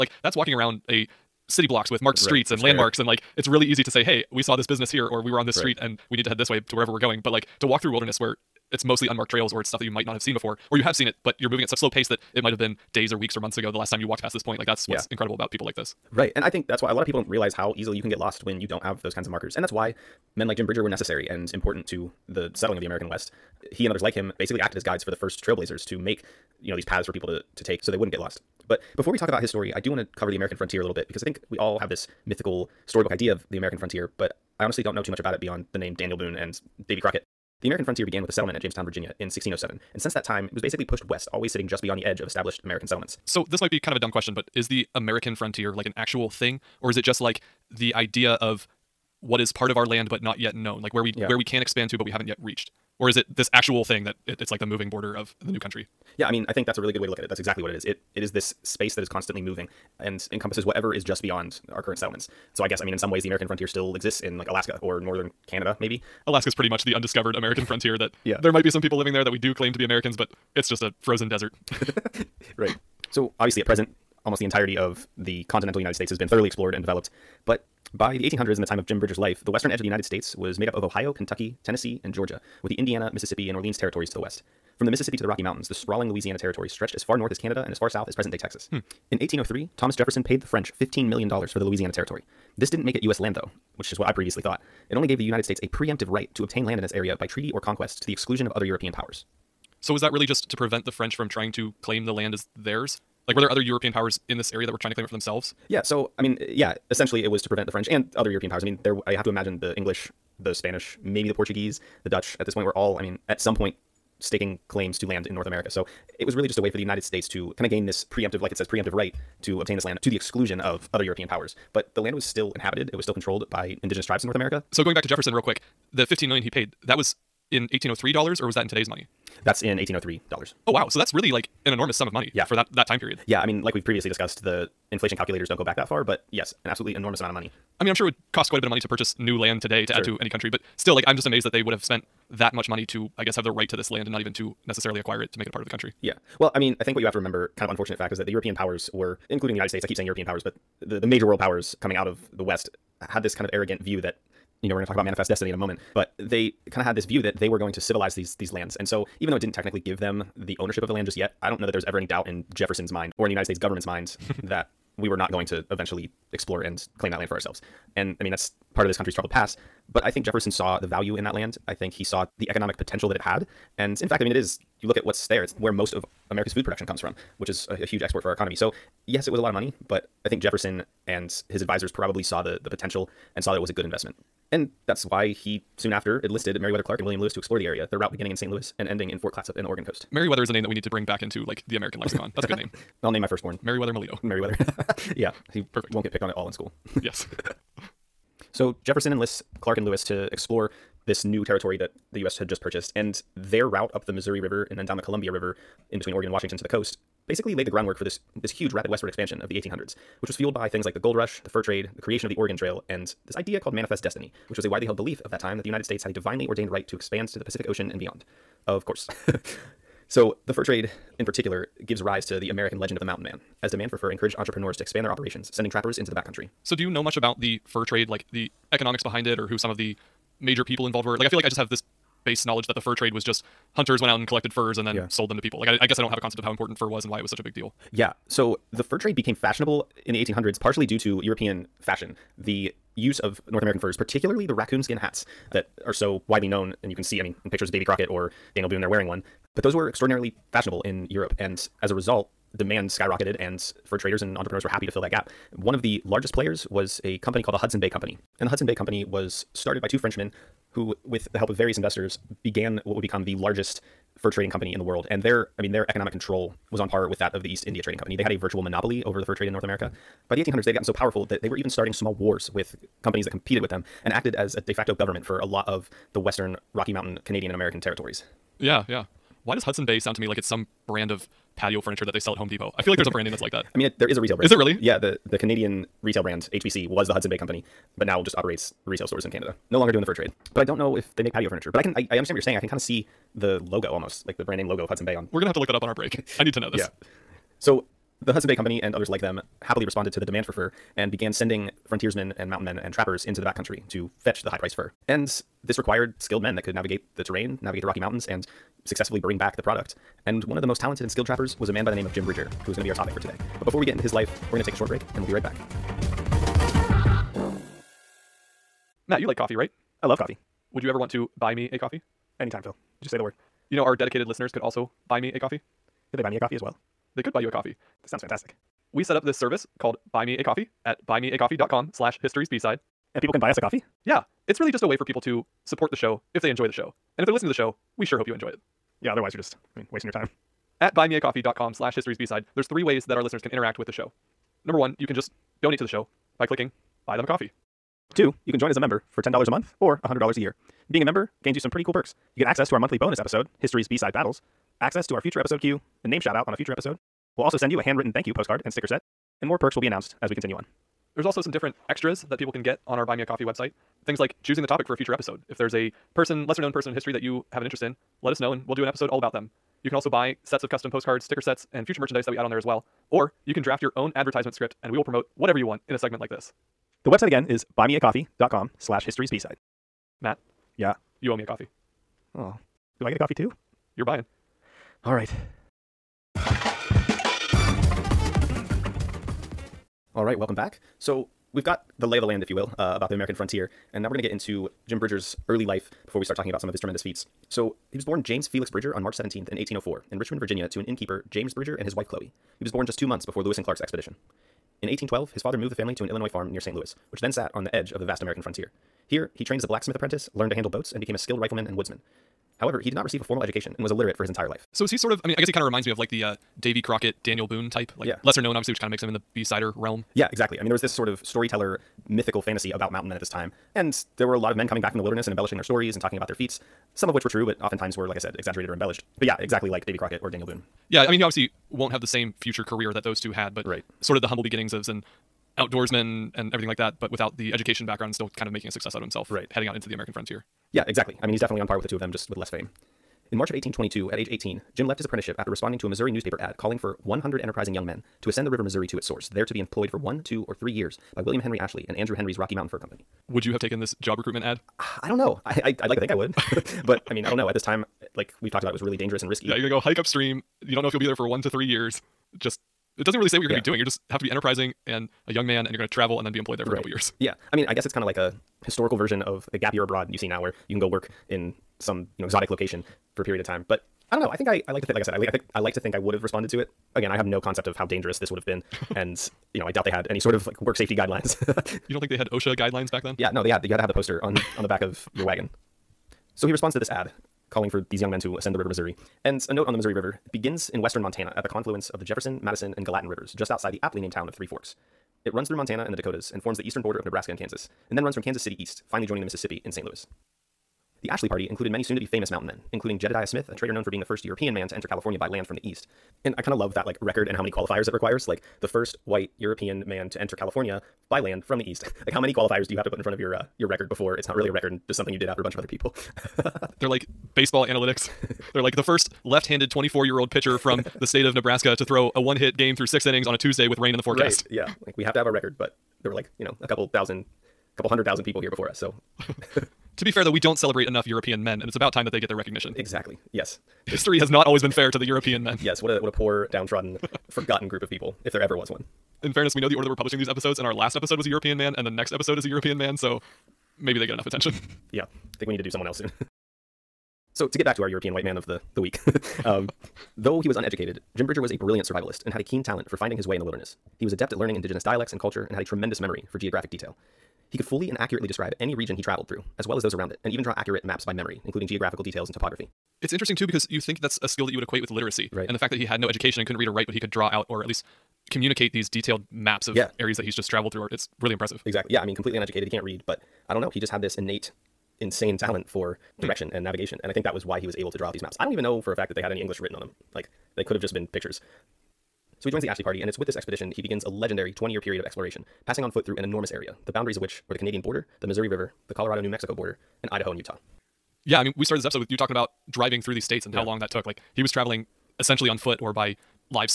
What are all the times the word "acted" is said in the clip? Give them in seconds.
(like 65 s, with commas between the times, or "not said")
24 s, 274 s.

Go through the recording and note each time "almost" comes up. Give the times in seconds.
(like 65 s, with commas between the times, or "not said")
74 s, 293 s.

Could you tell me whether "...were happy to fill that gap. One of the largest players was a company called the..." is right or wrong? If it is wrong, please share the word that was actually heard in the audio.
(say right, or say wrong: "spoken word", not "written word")
right.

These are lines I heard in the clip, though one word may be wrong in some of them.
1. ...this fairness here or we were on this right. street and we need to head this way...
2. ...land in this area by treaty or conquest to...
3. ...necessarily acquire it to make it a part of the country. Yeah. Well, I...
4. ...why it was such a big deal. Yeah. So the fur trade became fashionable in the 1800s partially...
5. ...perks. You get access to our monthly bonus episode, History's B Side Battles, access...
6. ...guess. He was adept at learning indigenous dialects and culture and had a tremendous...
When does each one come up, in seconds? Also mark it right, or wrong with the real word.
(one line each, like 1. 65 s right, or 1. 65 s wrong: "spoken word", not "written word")
1. 4 s wrong: "business", not "fairness"
2. 96 s right
3. 144 s right
4. 237 s right
5. 351 s right
6. 553 s wrong: "wilderness", not "guess".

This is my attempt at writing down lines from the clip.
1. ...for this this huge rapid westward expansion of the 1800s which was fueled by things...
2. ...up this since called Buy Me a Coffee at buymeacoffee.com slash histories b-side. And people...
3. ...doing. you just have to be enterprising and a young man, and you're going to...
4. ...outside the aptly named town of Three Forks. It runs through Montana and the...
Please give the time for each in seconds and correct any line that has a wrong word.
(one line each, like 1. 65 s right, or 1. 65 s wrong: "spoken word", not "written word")
1. 207 s right
2. 329 s wrong: "service", not "since"
3. 463 s right
4. 493 s right.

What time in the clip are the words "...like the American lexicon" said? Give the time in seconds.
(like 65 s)
191 s.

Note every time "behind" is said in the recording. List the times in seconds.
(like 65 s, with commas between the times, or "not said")
229 s.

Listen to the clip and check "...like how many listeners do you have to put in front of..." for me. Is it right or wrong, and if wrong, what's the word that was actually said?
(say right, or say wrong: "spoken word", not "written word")
wrong: "qualifiers", not "listeners".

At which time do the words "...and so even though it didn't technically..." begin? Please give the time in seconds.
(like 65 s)
158 s.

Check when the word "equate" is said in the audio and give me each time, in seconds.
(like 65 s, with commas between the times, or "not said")
564 s.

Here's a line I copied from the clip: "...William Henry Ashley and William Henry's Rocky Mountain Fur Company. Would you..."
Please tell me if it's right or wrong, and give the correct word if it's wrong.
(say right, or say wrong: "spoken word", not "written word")
wrong: "Andrew", not "William".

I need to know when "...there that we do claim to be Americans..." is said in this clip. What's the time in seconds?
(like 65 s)
69 s.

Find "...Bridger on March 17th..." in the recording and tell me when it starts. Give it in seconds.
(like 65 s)
398 s.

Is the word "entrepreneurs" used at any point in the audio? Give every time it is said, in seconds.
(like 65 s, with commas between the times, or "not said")
224 s, 254 s.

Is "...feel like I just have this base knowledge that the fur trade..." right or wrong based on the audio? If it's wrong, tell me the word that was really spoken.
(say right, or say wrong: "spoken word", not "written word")
right.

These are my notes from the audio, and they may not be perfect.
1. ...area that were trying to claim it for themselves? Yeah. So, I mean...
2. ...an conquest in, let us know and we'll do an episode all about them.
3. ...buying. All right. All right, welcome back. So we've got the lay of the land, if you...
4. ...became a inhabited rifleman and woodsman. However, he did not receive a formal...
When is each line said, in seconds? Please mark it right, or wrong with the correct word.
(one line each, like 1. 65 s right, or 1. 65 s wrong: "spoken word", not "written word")
1. 104 s right
2. 367 s wrong: "interest", not "conquest"
3. 384 s right
4. 411 s wrong: "skilled", not "inhabited".